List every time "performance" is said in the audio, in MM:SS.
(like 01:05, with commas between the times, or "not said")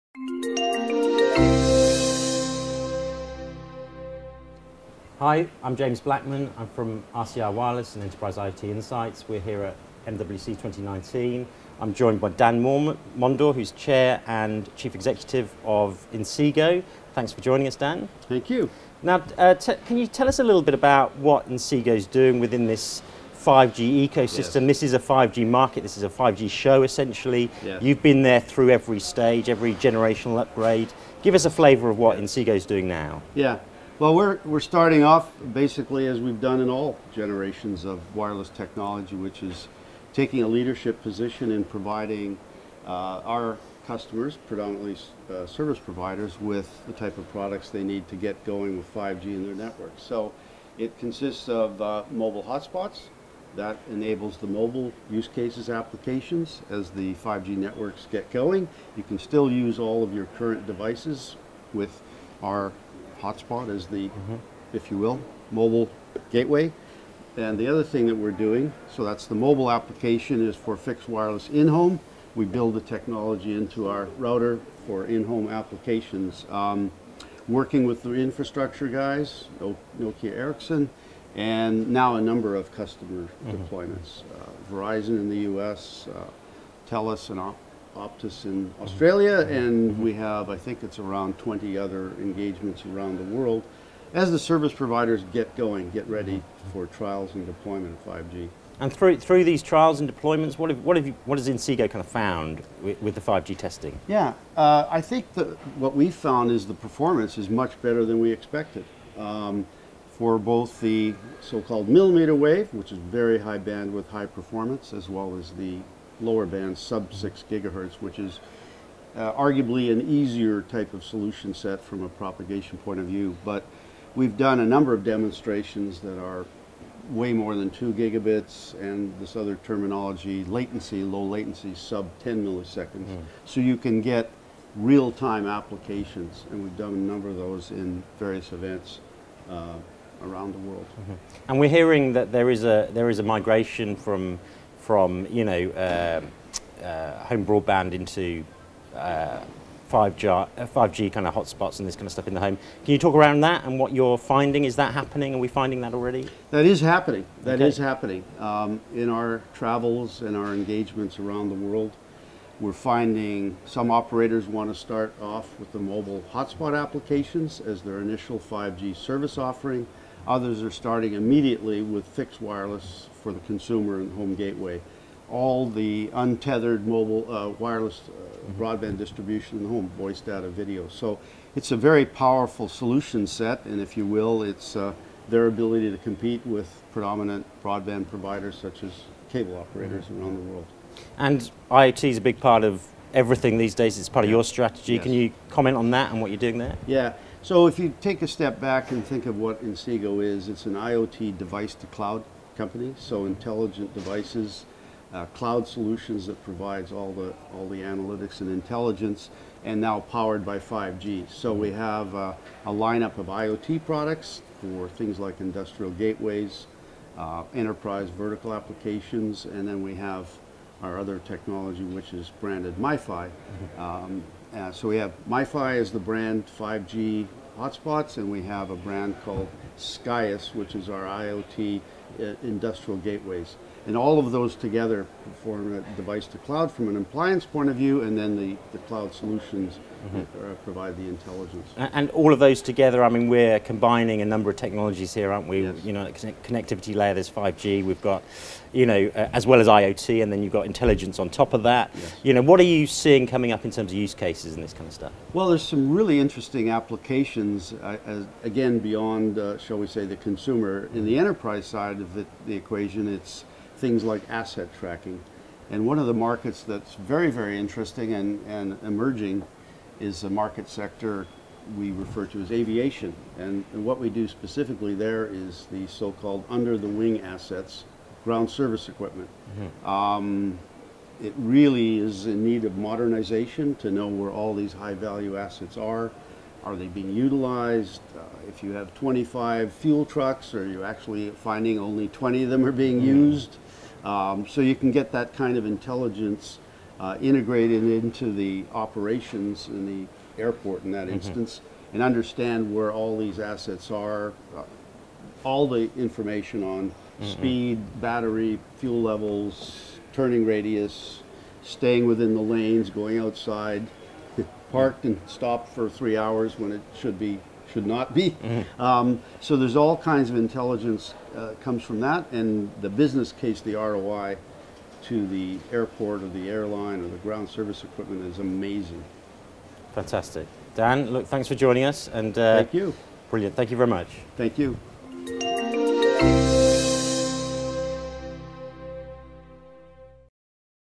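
01:46, 01:54.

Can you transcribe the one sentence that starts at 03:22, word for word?
So intelligent devices, uh, cloud solutions that provides all the all the analytics and intelligence, and now powered by 5G.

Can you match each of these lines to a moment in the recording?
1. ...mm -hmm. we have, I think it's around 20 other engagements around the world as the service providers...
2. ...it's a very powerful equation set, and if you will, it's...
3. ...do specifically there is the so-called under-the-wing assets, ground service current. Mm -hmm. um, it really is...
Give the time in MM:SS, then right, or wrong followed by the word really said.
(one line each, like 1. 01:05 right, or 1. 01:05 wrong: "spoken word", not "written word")
1. 01:29 right
2. 03:01 wrong: "solution", not "equation"
3. 04:34 wrong: "equipment", not "current".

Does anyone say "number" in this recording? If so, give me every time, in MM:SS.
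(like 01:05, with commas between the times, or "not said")
01:22, 02:04, 02:16, 04:04.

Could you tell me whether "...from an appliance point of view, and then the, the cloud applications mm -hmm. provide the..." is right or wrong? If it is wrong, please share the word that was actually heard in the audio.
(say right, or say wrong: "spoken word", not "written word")
wrong: "solutions", not "applications".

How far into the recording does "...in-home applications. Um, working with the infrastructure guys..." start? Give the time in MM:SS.
01:15.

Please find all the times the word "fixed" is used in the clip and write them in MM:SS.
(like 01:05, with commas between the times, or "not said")
01:10, 02:52.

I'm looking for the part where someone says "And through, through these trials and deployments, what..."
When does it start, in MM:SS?
01:38.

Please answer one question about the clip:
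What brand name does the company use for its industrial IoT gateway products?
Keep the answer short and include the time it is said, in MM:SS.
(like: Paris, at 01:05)
Skyus, at 03:49.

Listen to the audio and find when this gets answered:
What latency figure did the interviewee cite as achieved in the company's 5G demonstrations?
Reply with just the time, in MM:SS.
02:11.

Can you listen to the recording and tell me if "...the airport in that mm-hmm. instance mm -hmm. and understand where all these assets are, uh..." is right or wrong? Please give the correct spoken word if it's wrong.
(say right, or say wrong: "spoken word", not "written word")
right.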